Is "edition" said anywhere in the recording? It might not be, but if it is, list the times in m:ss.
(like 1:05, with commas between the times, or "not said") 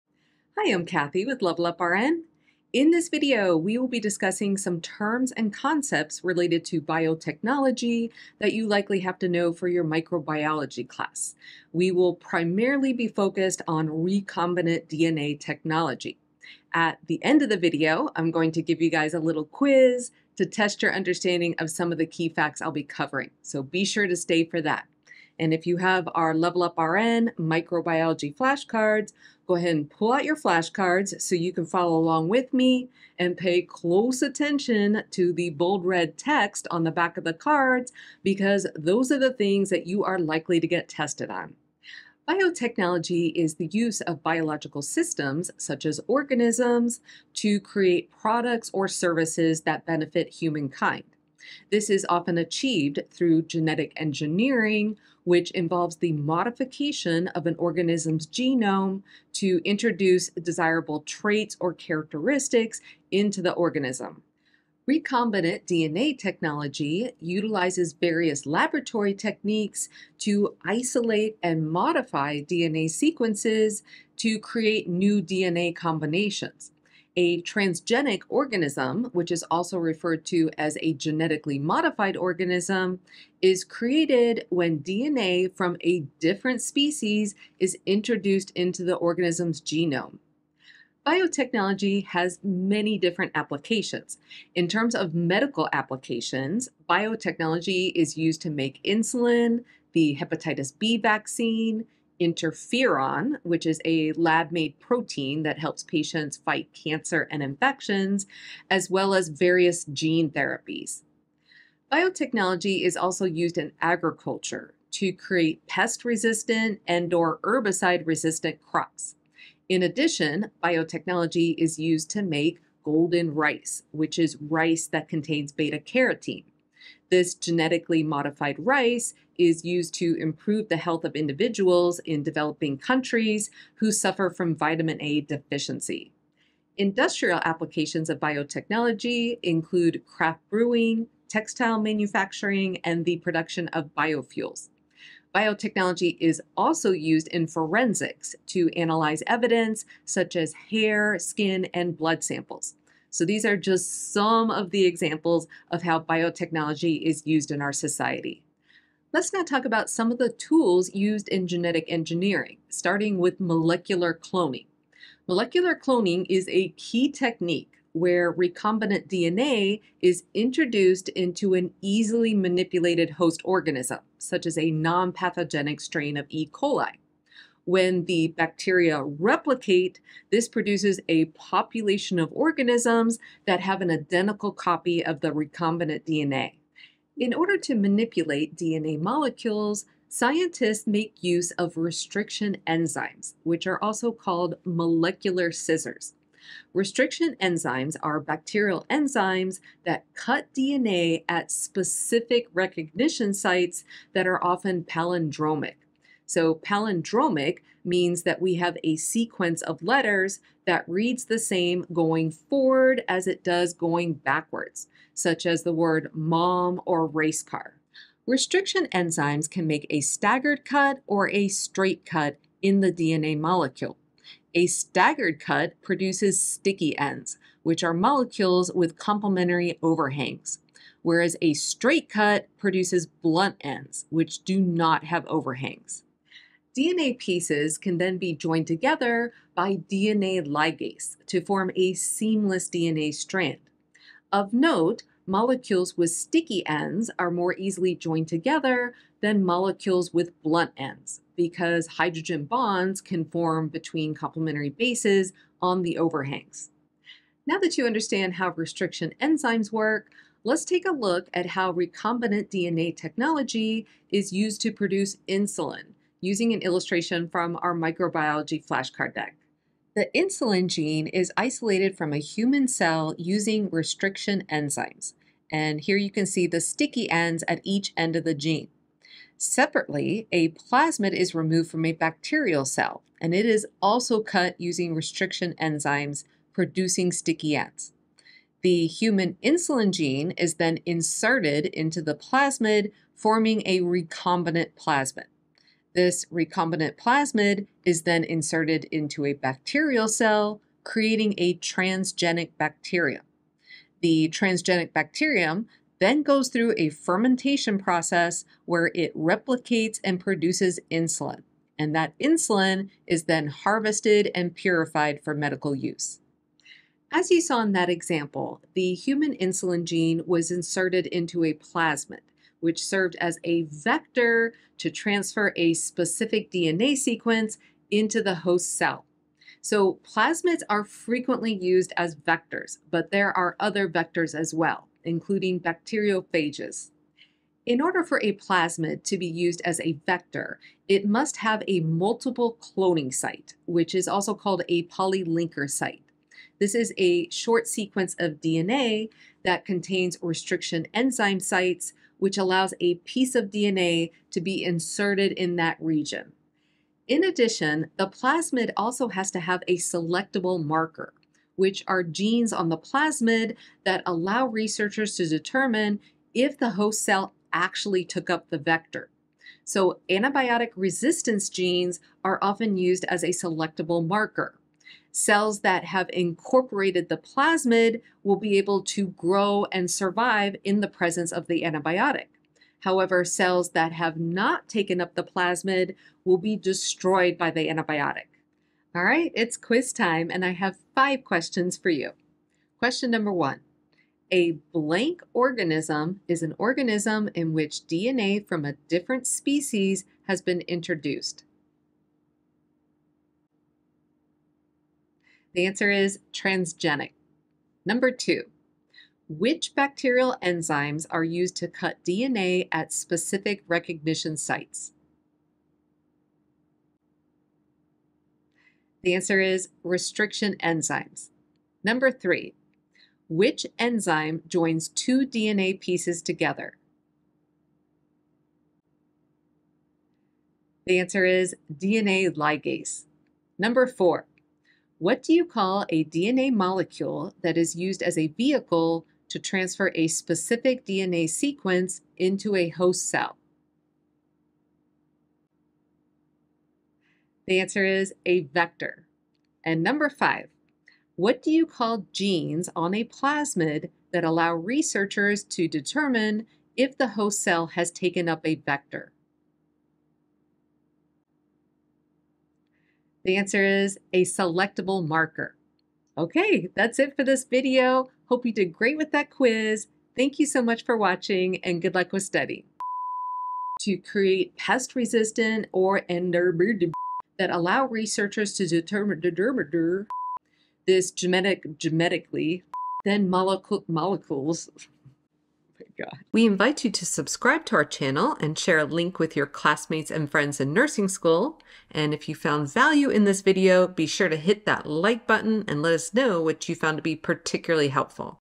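not said.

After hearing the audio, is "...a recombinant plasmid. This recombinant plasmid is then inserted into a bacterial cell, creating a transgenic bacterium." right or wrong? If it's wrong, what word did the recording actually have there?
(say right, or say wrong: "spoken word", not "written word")
right.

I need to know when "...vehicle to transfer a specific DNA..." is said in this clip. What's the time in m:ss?
7:18.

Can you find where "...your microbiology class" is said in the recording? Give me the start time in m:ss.
0:09.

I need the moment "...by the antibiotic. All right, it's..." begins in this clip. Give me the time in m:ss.
6:27.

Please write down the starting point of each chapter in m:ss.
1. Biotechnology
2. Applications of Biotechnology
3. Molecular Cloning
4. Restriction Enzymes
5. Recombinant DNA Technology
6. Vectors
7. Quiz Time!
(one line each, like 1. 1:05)
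1. 0:41
2. 1:30
3. 2:38
4. 3:06
5. 4:16
6. 5:16
7. 6:28.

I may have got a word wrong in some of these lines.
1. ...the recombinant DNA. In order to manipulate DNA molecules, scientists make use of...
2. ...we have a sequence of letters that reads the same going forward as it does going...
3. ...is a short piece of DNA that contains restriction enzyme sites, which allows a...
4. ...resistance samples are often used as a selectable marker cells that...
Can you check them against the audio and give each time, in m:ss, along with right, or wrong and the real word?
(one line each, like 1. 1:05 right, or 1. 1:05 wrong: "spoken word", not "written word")
1. 3:05 right
2. 3:28 right
3. 5:46 wrong: "sequence", not "piece"
4. 6:10 wrong: "genes", not "samples".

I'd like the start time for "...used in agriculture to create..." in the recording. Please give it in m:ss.
1:53.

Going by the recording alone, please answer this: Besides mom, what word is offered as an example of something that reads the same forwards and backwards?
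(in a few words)
Race car.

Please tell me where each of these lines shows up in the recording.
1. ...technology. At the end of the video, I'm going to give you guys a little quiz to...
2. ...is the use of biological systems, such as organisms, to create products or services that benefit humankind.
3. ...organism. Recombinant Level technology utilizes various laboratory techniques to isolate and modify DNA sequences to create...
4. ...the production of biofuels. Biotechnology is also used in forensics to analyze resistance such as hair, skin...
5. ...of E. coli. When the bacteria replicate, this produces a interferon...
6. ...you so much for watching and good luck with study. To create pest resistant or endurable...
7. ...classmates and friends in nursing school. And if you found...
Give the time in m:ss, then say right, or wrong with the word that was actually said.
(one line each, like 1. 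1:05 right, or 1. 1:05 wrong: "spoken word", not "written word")
1. 0:15 right
2. 0:43 right
3. 1:03 wrong: "DNA", not "Level"
4. 2:23 wrong: "evidence", not "resistance"
5. 2:56 wrong: "population", not "interferon"
6. 7:50 right
7. 8:09 right.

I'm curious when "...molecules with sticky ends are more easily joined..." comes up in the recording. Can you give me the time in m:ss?
4:05.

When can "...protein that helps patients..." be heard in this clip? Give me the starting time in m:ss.
1:44.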